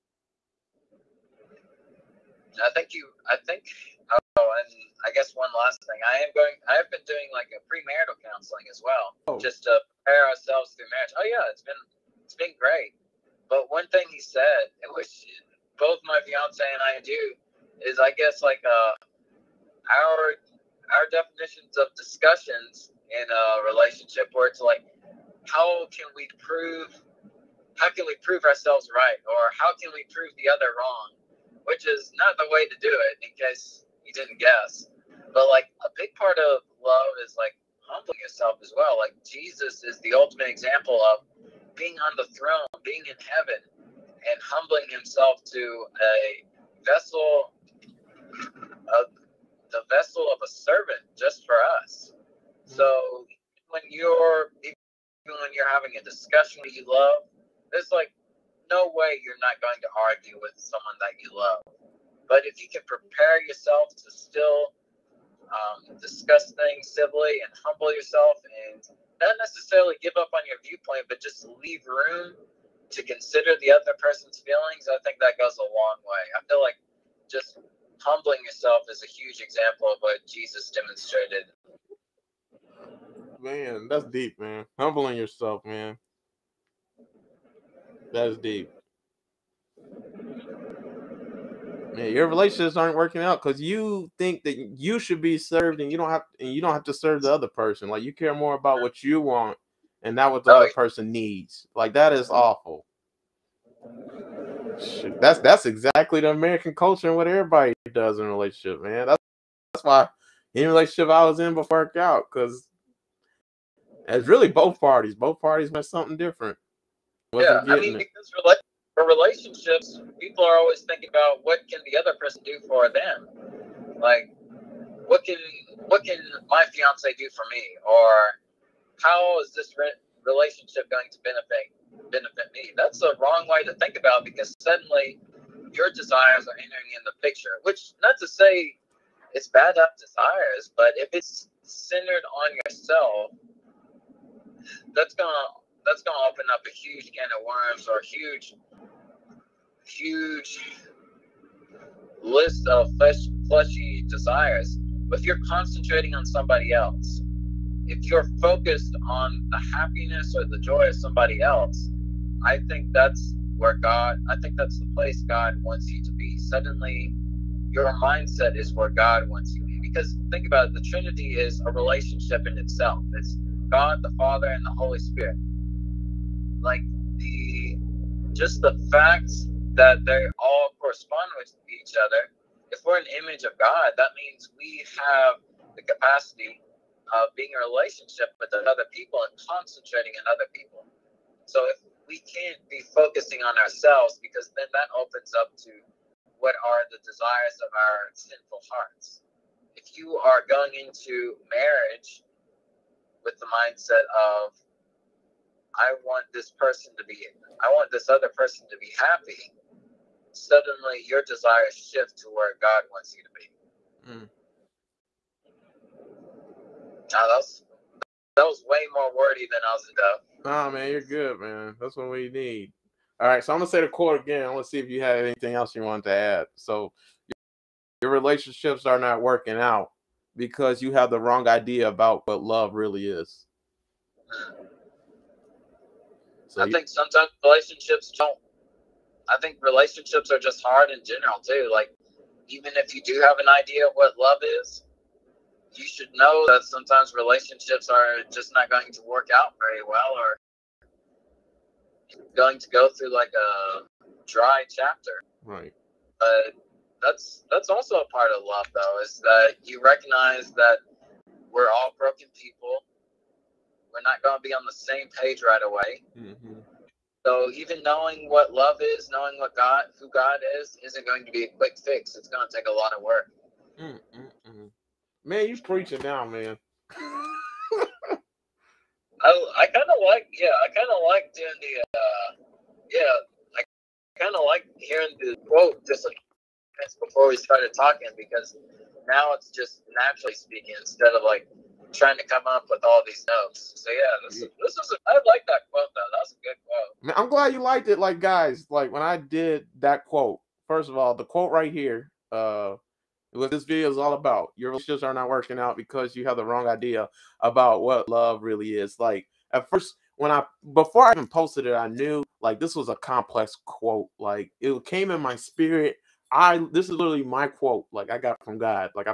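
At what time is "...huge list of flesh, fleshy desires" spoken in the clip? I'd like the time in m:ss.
2:29.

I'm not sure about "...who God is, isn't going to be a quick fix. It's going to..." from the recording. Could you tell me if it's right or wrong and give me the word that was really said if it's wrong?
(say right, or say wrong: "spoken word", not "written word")
right.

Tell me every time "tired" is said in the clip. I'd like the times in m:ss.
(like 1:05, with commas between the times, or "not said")
not said.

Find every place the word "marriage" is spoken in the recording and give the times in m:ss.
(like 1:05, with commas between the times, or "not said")
0:10, 3:21.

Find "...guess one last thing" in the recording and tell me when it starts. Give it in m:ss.
0:05.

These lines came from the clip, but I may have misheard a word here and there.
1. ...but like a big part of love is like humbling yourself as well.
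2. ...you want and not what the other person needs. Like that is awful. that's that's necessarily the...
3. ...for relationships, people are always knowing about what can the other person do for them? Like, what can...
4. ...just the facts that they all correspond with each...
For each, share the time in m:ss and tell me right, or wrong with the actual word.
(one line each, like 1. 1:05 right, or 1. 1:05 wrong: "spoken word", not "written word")
1. 0:35 right
2. 1:39 wrong: "exactly", not "necessarily"
3. 1:58 wrong: "thinking", not "knowing"
4. 2:58 right.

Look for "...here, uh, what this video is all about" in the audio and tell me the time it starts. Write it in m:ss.
5:01.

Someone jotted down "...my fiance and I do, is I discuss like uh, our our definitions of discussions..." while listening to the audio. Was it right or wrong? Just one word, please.
wrong.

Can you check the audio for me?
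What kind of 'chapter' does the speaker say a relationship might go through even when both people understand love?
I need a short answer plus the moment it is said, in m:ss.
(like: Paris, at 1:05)
A dry chapter, at 4:14.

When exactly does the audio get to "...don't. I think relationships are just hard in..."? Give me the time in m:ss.
3:58.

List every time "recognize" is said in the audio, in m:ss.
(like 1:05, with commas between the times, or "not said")
4:19.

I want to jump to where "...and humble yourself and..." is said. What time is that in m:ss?
1:07.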